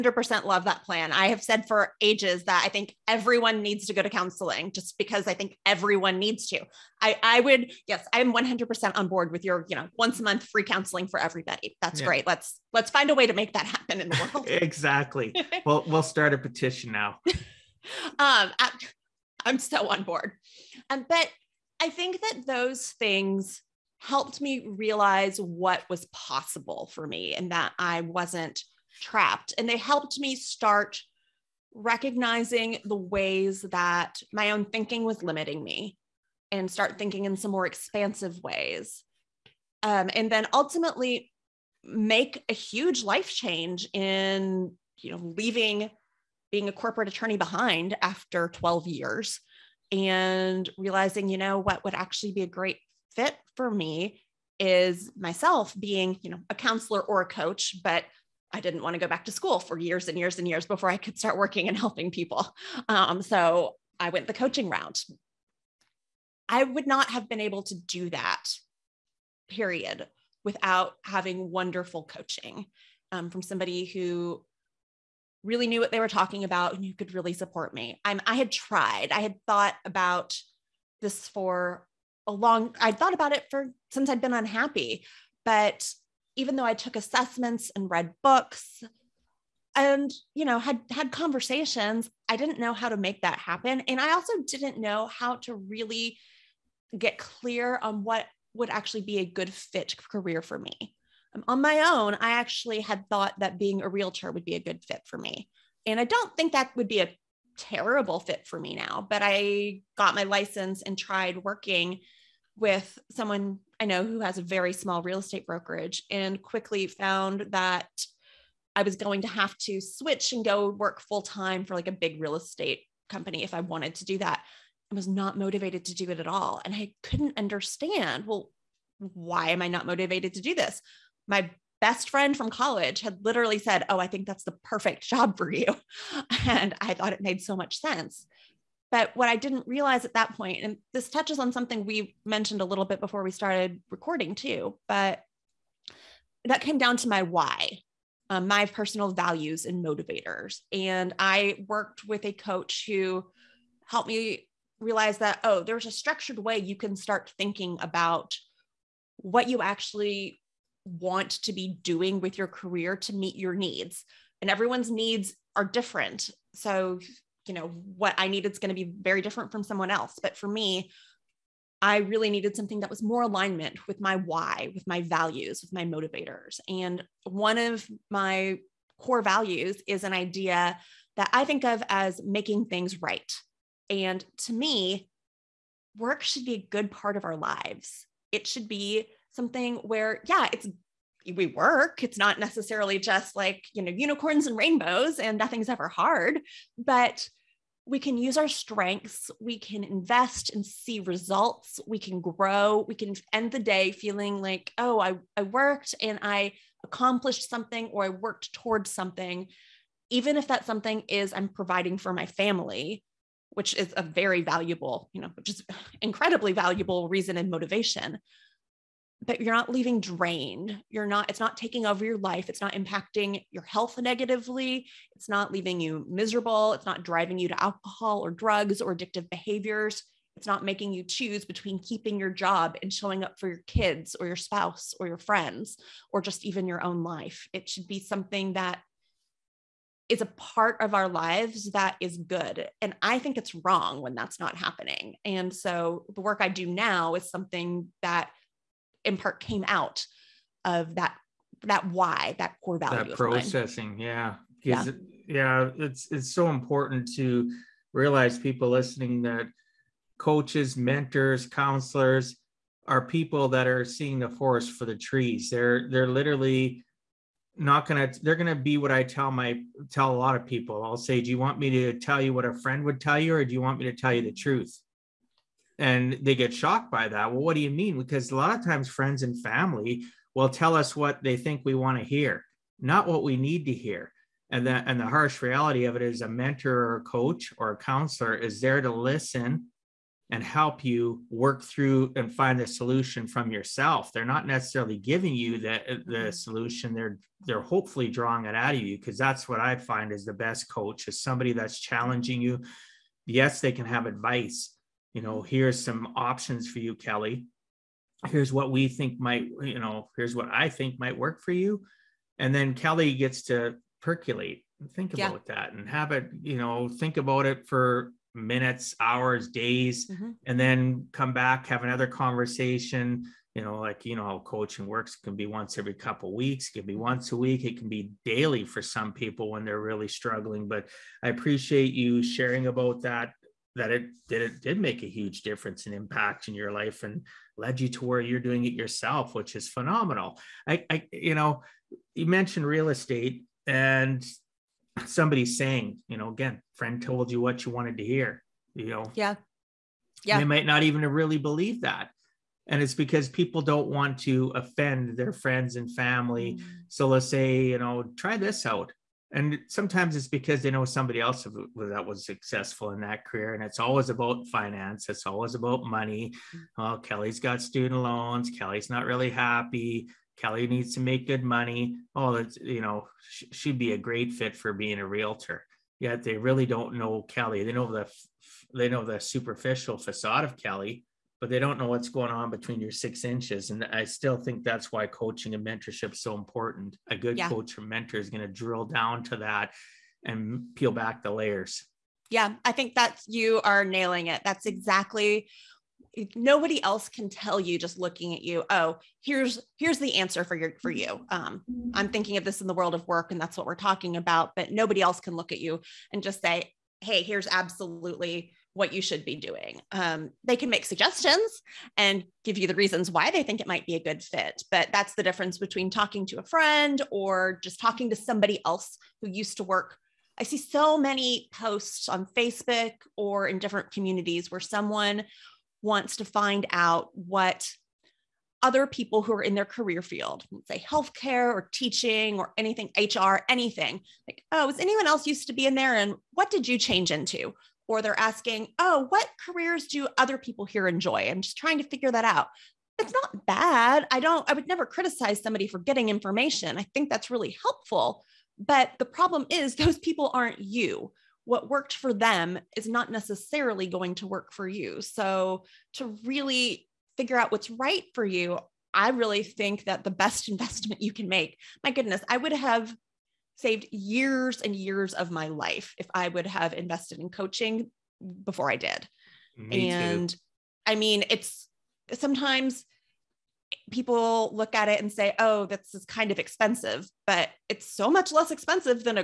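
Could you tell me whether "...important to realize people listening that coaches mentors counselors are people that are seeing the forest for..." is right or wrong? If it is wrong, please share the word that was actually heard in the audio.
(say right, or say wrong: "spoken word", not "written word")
right.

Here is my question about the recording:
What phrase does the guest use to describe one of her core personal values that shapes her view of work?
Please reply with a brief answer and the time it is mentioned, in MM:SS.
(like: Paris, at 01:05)
making things right, at 03:02.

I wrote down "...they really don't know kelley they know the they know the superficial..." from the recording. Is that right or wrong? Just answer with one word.
right.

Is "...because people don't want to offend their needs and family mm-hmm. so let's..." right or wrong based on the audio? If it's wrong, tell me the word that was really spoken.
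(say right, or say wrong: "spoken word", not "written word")
wrong: "friends", not "needs".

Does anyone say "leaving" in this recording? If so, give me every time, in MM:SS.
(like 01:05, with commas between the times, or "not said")
00:45, 03:39, 03:45.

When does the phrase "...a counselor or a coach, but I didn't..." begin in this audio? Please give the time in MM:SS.
00:56.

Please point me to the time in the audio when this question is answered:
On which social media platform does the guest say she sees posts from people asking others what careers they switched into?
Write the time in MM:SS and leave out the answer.
07:02.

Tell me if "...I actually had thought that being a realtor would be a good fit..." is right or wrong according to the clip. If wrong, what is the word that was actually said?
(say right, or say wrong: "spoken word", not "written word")
right.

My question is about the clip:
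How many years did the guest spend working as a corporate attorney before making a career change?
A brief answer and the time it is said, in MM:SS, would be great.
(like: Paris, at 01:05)
12 years, at 00:48.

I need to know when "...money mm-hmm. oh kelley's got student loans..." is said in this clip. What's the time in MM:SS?
06:05.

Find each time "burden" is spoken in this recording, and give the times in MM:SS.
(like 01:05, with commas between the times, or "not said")
not said.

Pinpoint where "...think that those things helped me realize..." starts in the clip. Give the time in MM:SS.
00:21.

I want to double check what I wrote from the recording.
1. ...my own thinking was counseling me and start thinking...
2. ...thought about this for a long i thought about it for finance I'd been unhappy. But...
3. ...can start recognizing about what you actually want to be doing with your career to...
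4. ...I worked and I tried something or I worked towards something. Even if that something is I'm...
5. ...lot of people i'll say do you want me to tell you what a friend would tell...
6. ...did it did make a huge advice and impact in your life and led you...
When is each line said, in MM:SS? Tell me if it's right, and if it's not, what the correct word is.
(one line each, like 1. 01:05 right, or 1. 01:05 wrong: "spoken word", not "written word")
1. 00:34 wrong: "limiting", not "counseling"
2. 01:19 wrong: "since", not "finance"
3. 02:36 wrong: "thinking", not "recognizing"
4. 03:25 wrong: "accomplished", not "tried"
5. 04:30 right
6. 05:34 wrong: "difference", not "advice".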